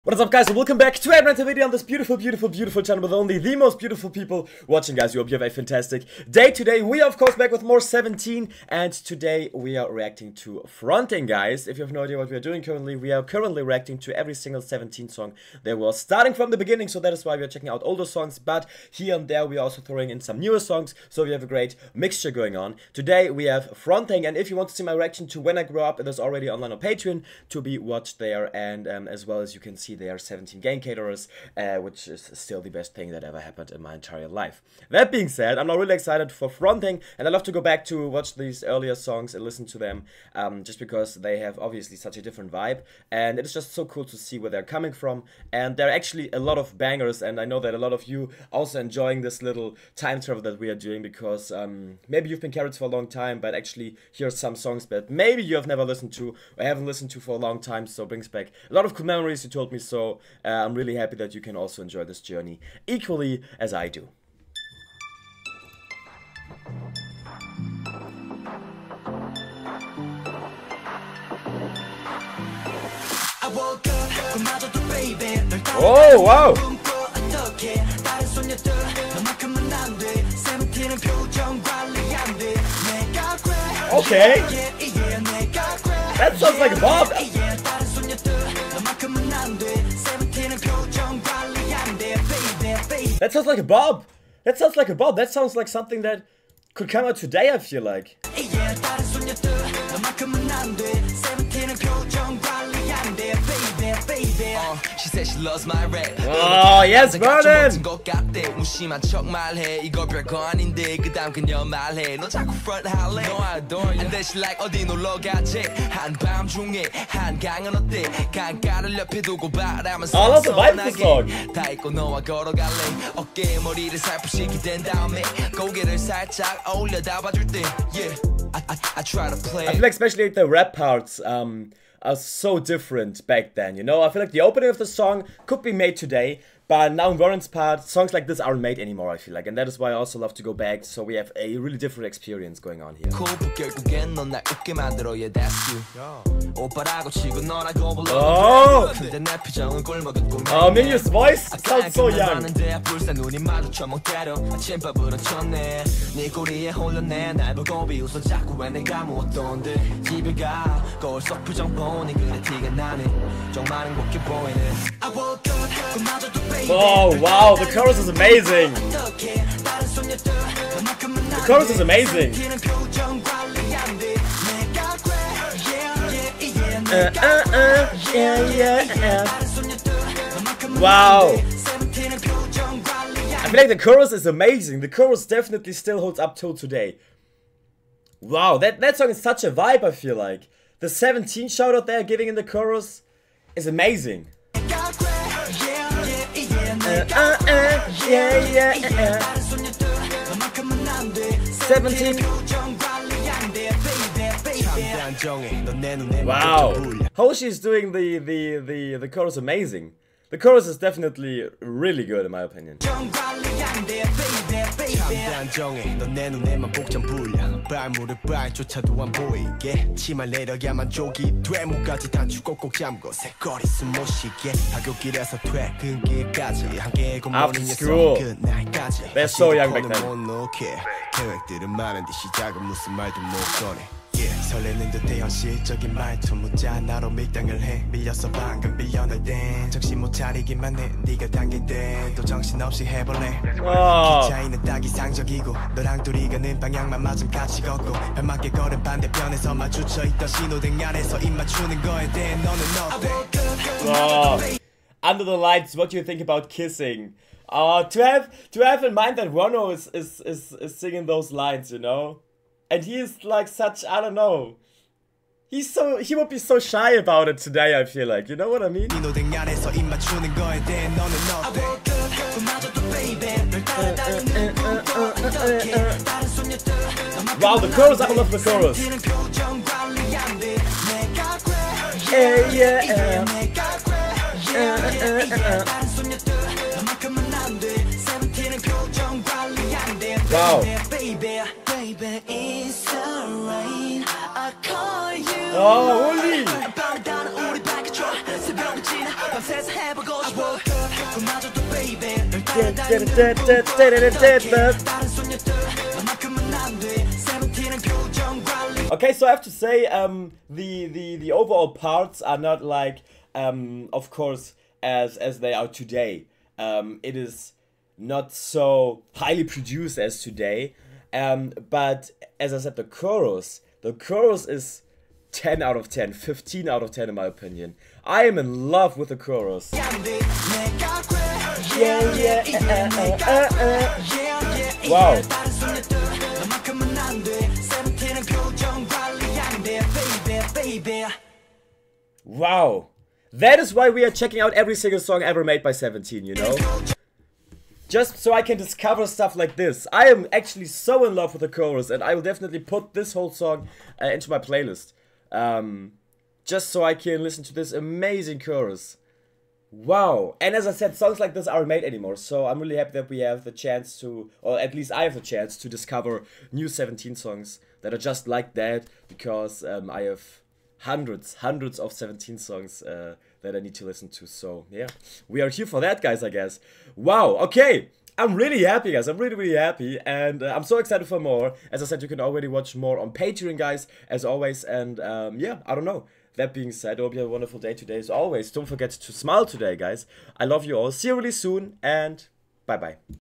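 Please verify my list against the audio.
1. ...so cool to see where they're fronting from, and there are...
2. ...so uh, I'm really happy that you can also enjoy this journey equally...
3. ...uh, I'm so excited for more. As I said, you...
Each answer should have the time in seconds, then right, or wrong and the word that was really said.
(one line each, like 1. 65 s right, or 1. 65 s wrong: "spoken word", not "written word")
1. 43 s wrong: "coming", not "fronting"
2. 59 s right
3. 380 s right.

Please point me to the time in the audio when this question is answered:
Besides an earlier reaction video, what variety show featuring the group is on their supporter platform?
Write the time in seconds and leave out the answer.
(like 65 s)
30 s.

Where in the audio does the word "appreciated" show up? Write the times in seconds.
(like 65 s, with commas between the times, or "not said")
not said.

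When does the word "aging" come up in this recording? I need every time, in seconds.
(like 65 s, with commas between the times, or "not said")
not said.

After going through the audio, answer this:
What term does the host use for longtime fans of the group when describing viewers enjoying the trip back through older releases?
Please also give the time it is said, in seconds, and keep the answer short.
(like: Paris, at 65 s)
Carats, at 52 s.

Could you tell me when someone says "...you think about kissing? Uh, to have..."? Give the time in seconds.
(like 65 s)
255 s.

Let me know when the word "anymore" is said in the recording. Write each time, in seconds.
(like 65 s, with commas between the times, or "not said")
138 s, 361 s.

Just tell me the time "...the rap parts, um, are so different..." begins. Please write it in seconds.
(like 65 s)
130 s.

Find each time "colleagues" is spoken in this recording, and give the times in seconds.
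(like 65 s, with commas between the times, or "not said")
not said.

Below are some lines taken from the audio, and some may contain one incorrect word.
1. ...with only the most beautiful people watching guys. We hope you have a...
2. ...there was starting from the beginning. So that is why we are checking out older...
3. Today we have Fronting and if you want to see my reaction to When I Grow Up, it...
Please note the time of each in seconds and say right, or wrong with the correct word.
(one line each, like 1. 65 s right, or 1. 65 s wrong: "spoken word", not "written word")
1. 3 s right
2. 15 s right
3. 22 s right.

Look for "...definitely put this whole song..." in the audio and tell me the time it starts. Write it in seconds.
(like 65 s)
352 s.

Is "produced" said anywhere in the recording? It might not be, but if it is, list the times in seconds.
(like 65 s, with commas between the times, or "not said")
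319 s.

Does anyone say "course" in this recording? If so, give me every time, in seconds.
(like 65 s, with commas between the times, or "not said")
7 s, 314 s.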